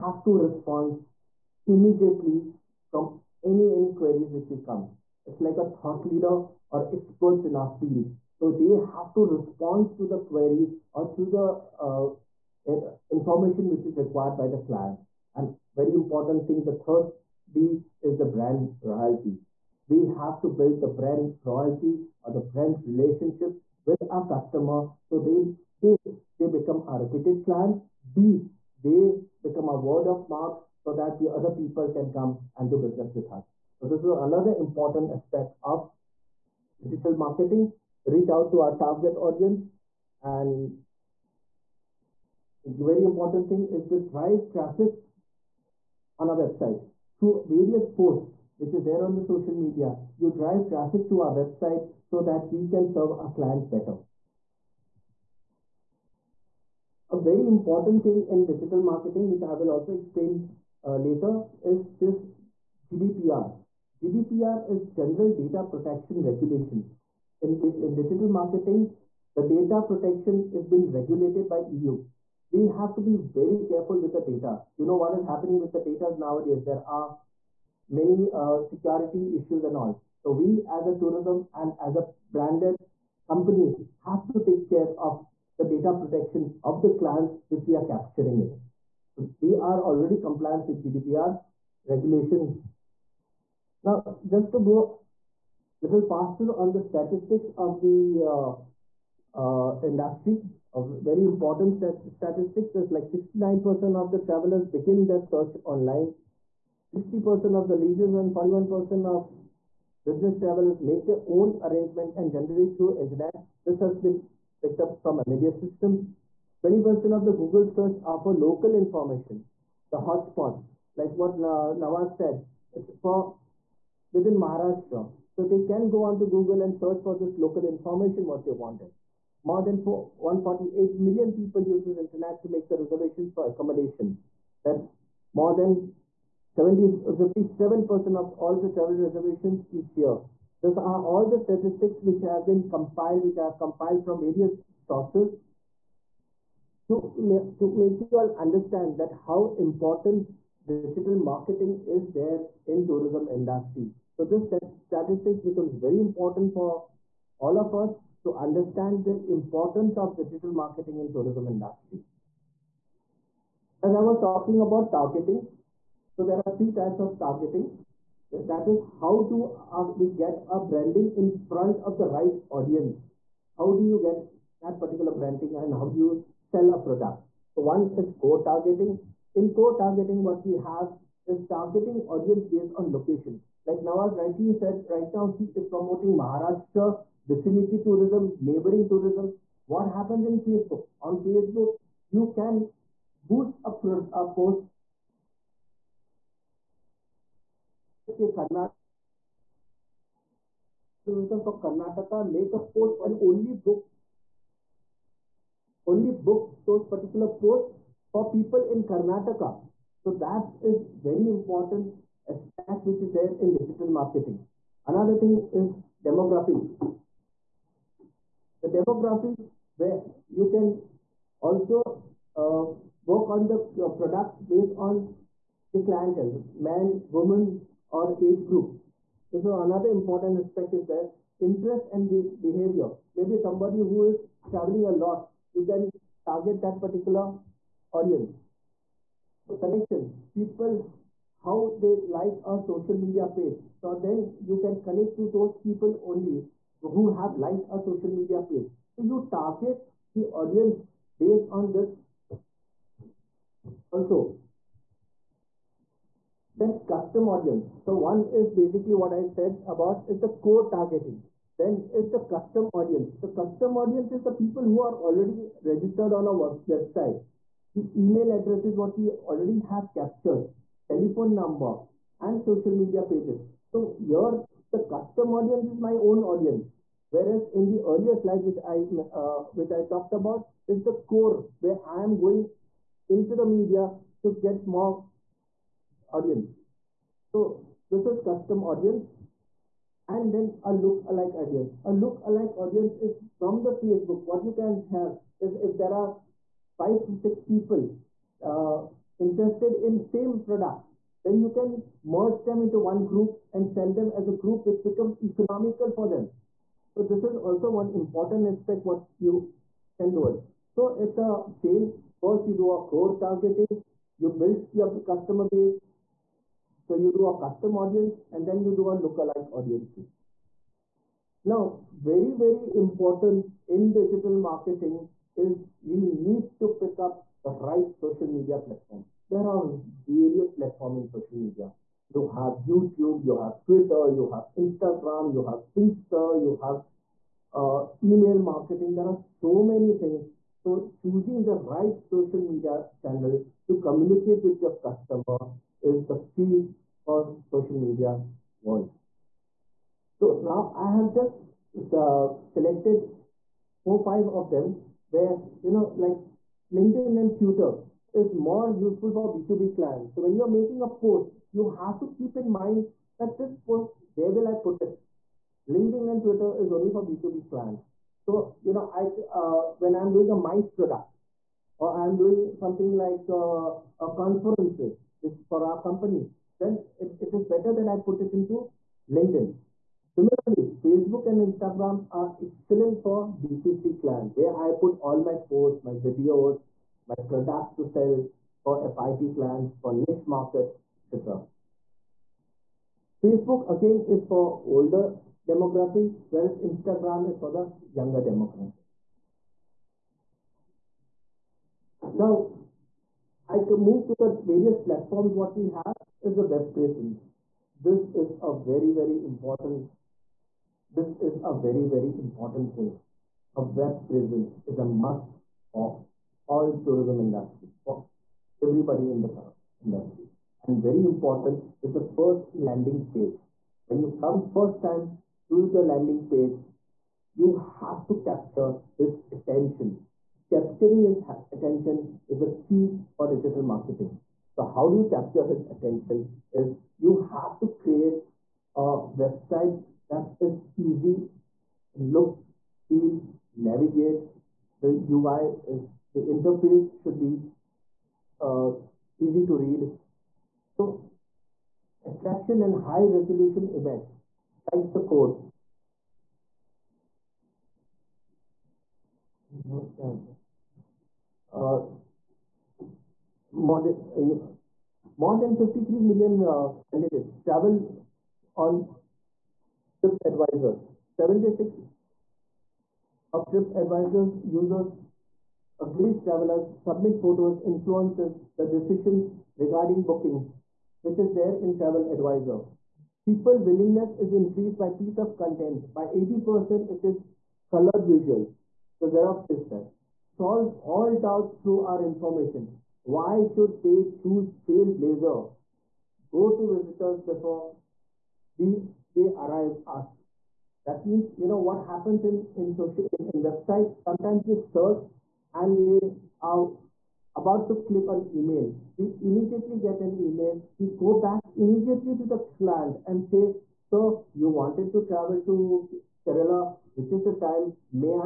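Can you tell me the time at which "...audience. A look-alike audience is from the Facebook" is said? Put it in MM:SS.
04:51.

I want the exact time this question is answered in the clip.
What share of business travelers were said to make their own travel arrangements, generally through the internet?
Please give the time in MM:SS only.
01:48.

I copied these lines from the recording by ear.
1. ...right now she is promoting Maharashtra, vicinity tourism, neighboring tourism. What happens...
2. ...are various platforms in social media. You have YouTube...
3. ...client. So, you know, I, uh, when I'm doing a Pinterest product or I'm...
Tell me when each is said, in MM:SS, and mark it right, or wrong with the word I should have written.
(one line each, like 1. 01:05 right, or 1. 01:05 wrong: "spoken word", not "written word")
1. 03:04 right
2. 05:29 right
3. 06:07 wrong: "MICE", not "Pinterest".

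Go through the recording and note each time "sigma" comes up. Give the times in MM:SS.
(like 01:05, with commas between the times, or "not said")
not said.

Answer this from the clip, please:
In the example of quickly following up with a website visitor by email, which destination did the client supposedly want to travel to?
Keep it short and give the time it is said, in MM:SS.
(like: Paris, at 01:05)
Kerala, at 08:36.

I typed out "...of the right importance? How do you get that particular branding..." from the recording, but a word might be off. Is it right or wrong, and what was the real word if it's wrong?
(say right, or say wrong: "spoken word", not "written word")
wrong: "audience", not "importance".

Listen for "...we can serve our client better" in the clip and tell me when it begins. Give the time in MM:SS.
00:52.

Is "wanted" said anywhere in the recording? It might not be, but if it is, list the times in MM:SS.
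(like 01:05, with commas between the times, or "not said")
02:08, 08:34.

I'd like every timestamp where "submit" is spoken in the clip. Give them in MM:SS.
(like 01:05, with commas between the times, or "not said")
07:56.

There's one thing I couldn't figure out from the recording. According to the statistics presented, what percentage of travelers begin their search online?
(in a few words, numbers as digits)
69%.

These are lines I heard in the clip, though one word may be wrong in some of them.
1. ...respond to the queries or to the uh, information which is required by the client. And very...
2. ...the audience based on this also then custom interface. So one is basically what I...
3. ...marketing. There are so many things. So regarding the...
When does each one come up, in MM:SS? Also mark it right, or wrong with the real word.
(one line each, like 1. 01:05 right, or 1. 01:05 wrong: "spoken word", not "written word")
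1. 00:09 right
2. 04:10 wrong: "audience", not "interface"
3. 05:38 wrong: "choosing", not "regarding".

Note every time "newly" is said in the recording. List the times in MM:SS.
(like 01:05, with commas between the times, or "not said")
not said.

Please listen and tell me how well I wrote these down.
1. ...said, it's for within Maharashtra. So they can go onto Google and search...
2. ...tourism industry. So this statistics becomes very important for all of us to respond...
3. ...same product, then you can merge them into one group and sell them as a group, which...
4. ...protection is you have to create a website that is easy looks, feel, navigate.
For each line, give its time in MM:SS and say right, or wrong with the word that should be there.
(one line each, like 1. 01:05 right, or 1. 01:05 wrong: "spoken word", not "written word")
1. 02:02 right
2. 02:32 wrong: "understand", not "respond"
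3. 04:59 right
4. 07:15 wrong: "attention", not "protection".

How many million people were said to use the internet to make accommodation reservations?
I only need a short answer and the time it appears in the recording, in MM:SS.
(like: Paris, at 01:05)
148 million, at 02:09.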